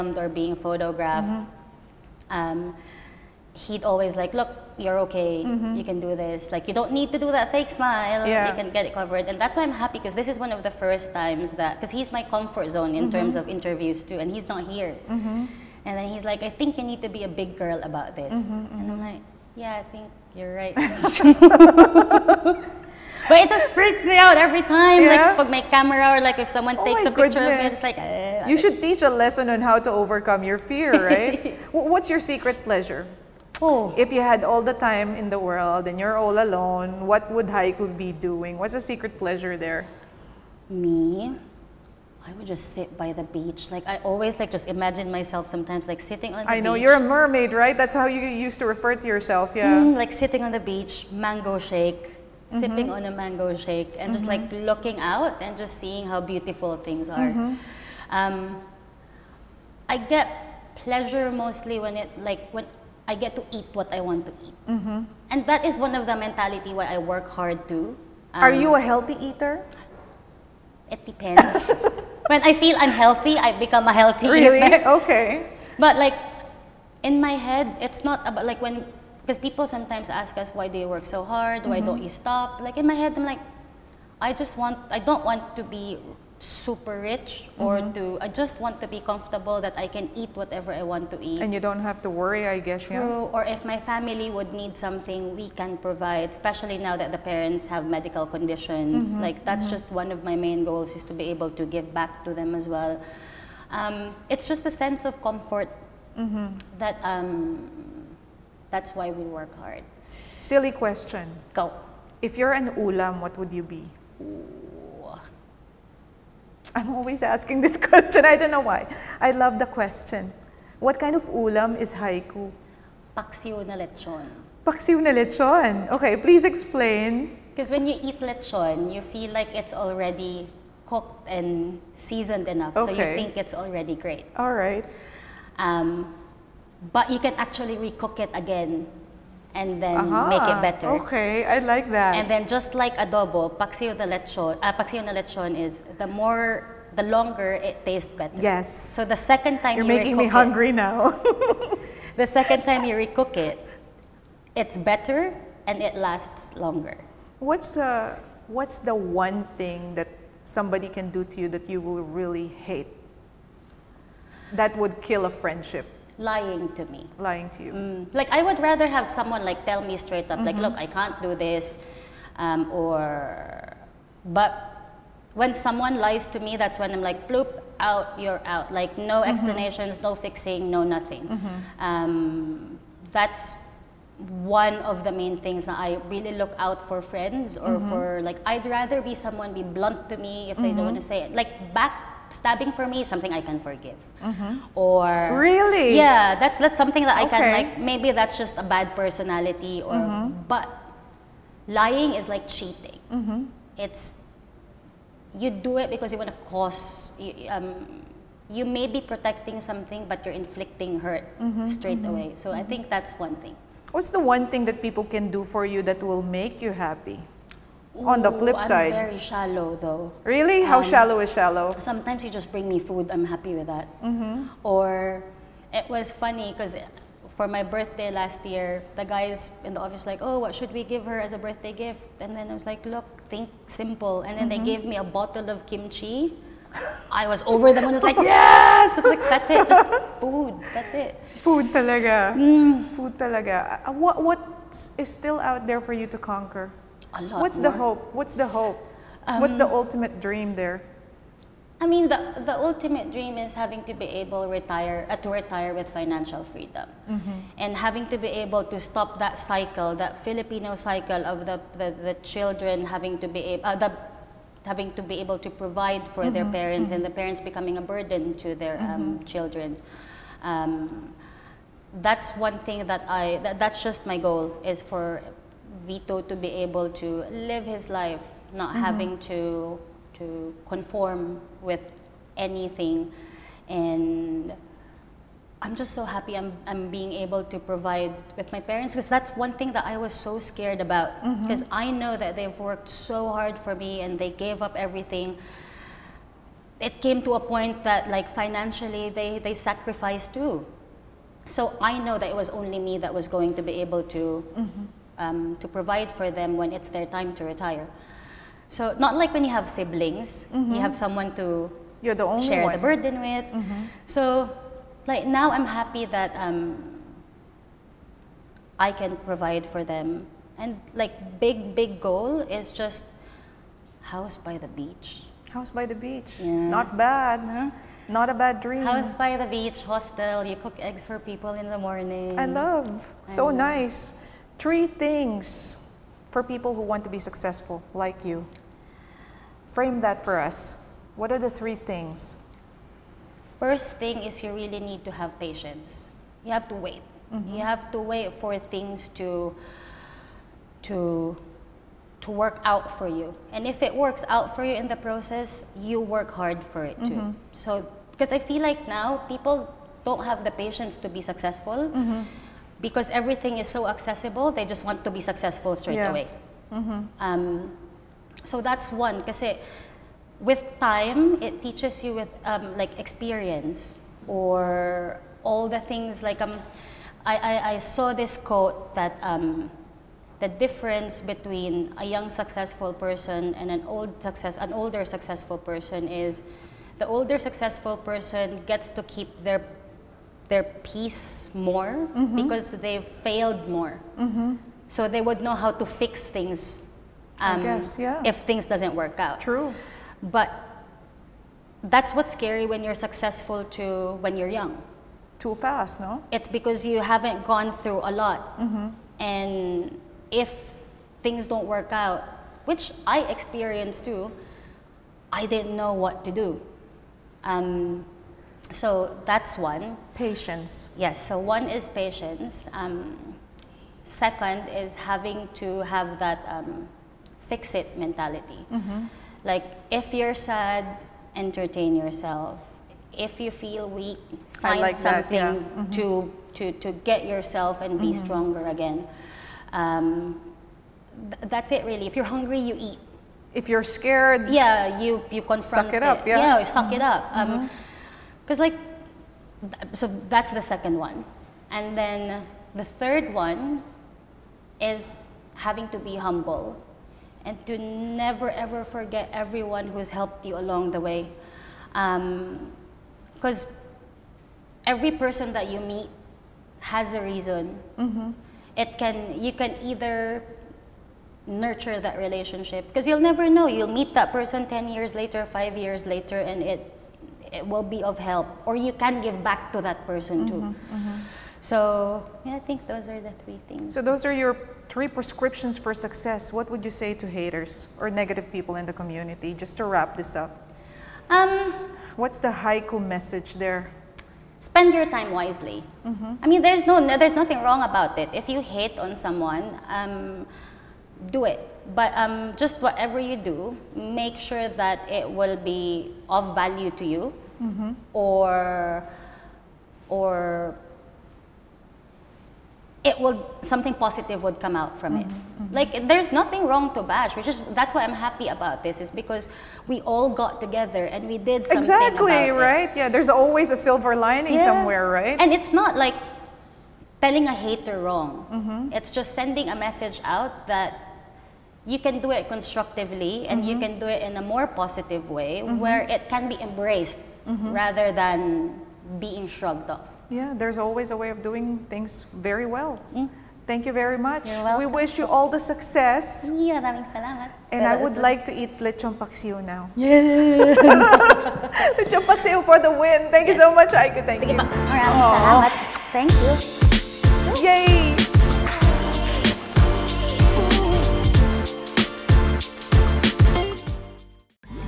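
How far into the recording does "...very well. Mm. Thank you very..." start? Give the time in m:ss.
9:02.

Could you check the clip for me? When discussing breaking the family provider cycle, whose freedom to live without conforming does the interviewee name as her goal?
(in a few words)
Vito.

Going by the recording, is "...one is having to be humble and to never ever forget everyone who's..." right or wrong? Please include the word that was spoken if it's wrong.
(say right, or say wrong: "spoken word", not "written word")
right.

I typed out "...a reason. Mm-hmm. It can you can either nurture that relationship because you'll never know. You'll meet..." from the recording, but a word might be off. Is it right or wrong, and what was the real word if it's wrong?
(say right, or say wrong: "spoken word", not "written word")
right.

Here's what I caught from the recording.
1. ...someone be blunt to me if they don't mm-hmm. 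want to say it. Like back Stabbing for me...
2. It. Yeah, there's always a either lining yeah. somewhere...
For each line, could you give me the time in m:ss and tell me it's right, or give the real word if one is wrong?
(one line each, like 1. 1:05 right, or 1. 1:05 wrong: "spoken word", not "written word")
1. 3:09 right
2. 8:42 wrong: "silver", not "either".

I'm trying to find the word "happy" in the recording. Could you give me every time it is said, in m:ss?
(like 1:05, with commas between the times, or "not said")
0:09, 3:36, 3:43, 4:46, 5:15, 8:38.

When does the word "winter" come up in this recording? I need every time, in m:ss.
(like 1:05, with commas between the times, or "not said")
not said.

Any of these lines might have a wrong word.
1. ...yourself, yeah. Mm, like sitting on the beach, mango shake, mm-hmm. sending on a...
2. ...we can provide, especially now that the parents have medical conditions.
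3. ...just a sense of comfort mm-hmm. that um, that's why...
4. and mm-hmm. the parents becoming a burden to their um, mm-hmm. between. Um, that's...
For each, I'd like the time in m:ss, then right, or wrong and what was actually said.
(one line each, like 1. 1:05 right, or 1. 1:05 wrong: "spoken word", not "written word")
1. 0:49 wrong: "sipping", not "sending"
2. 1:35 right
3. 1:44 right
4. 4:26 wrong: "children", not "between".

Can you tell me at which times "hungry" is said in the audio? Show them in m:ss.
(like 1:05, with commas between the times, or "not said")
2:30, 7:22.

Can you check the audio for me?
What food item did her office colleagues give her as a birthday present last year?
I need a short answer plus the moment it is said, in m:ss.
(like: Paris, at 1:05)
A bottle of kimchi, at 3:55.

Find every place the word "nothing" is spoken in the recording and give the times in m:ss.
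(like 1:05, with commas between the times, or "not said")
3:00, 8:17, 8:36.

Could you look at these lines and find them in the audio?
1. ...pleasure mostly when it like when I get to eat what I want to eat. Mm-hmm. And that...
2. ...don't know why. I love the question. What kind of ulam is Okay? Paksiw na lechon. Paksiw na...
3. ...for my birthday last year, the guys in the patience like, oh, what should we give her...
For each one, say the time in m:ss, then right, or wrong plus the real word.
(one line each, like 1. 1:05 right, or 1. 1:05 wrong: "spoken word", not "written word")
1. 1:00 right
2. 1:58 wrong: "Hyku", not "Okay"
3. 3:47 wrong: "office", not "patience".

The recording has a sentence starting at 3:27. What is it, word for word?
um, you may be protecting something, but you're inflicting hurt mm-hmm.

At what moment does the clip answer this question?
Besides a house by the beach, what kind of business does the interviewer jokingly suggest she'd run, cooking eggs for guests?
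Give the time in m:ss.
5:29.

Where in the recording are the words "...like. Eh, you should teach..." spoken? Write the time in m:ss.
0:27.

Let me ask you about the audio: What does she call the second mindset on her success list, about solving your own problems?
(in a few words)
Fix it mentality.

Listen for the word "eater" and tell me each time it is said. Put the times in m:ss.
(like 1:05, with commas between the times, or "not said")
1:09, 1:14.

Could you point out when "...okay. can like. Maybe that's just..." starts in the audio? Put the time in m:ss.
3:17.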